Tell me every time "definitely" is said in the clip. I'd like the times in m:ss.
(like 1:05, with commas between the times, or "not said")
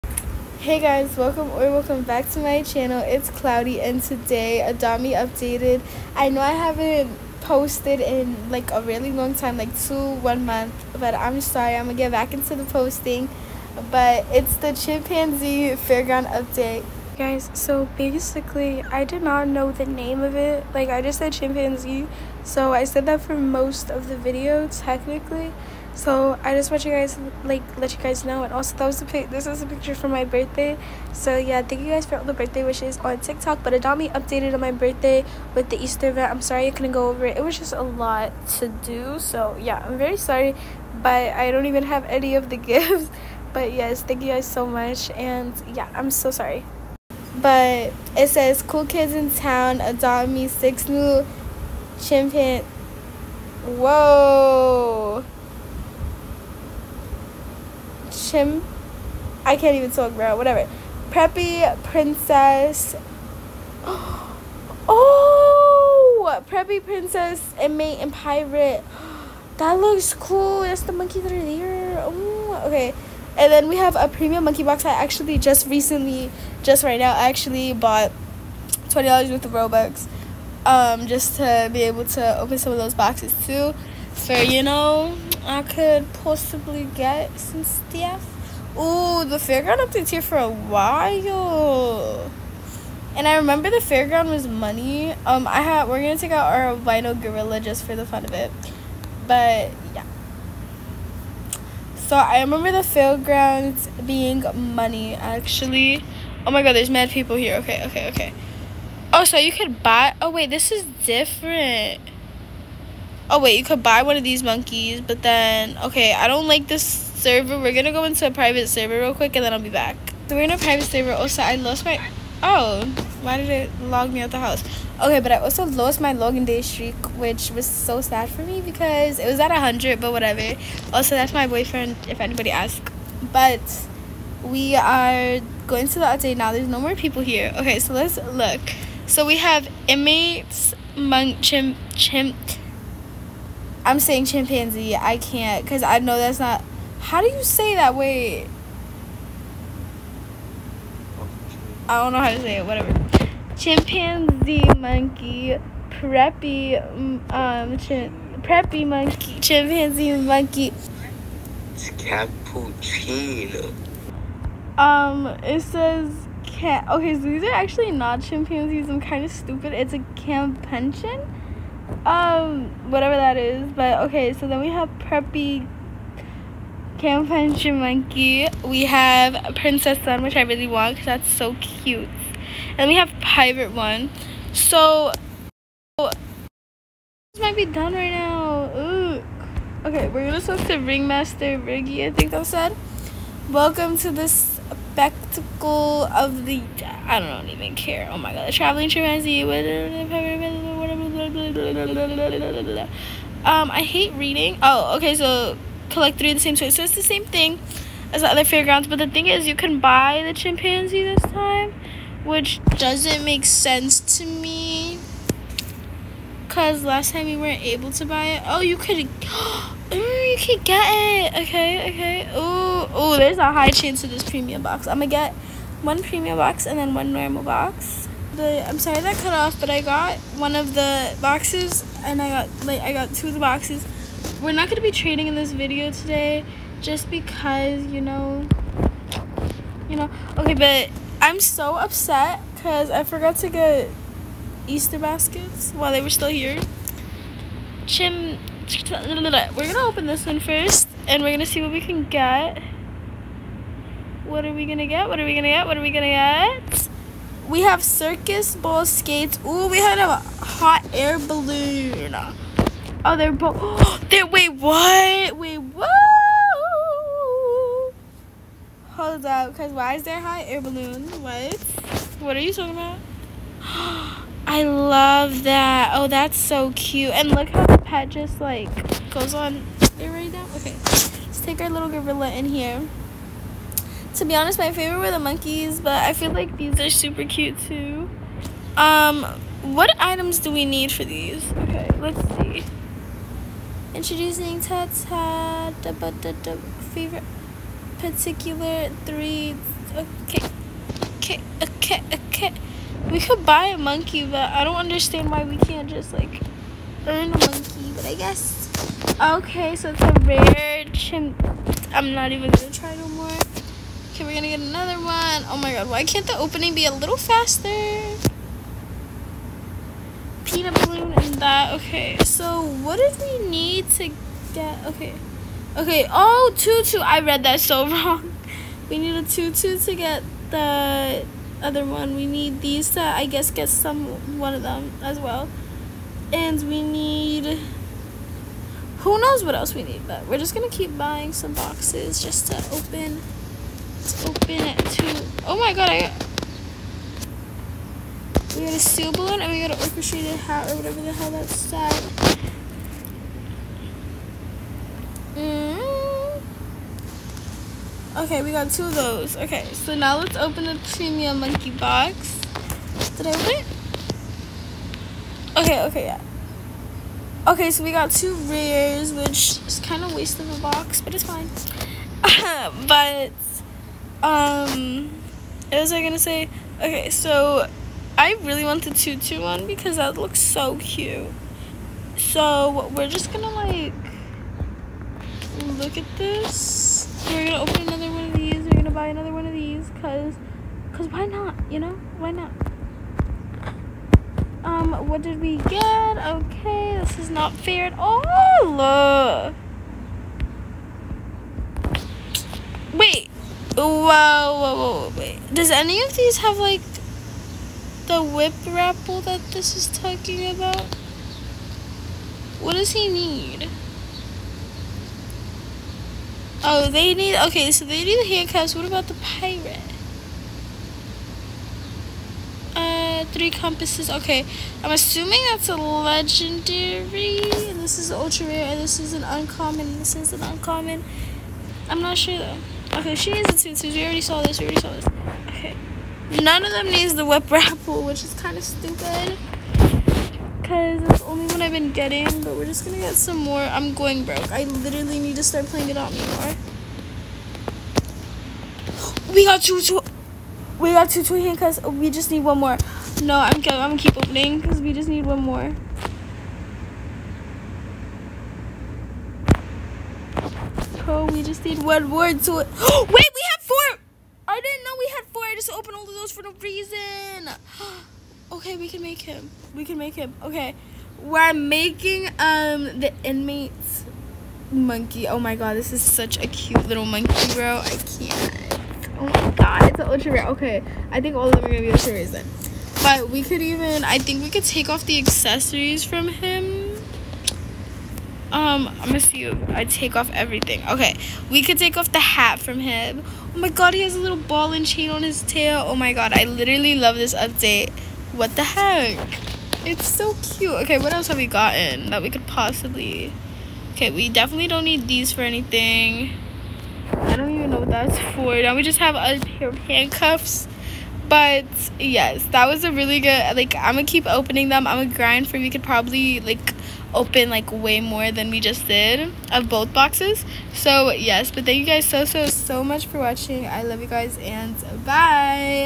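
8:24.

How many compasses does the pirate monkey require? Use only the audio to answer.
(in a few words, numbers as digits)
3.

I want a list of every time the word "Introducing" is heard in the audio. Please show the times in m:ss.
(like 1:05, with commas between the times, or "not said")
4:53.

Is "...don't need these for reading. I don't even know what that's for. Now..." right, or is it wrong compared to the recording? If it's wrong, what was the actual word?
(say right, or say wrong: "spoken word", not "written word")
wrong: "anything", not "reading".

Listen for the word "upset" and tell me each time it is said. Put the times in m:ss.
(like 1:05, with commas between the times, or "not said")
4:01.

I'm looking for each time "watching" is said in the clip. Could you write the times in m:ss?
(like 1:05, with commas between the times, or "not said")
8:43.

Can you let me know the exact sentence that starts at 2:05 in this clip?
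Okay, but I also lost my login day streak, which was so sad for me because it was at 100, but whatever.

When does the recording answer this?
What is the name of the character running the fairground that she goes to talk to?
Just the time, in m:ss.
3:10.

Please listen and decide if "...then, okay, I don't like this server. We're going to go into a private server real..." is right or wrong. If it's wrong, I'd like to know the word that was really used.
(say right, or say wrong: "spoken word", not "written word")
right.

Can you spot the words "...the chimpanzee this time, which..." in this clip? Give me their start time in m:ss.
3:30.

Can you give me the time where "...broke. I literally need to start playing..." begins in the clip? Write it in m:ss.
7:24.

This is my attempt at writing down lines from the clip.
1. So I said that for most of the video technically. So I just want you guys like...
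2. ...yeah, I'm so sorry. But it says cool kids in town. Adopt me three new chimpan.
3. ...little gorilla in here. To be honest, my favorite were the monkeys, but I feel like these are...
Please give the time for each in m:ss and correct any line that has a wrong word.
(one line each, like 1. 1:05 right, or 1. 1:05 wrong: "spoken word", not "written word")
1. 0:22 right
2. 0:45 wrong: "six", not "three"
3. 4:41 right.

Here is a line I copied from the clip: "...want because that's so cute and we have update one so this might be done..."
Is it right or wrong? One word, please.
wrong.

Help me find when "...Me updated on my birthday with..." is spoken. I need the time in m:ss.
0:33.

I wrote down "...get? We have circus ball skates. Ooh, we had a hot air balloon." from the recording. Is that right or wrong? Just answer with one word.
right.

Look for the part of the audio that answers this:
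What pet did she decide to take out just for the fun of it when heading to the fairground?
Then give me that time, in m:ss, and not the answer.
1:36.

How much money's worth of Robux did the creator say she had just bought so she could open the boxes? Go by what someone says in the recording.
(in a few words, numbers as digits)
$20.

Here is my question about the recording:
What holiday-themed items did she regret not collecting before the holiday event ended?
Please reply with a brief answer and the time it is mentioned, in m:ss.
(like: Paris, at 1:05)
Easter baskets, at 4:04.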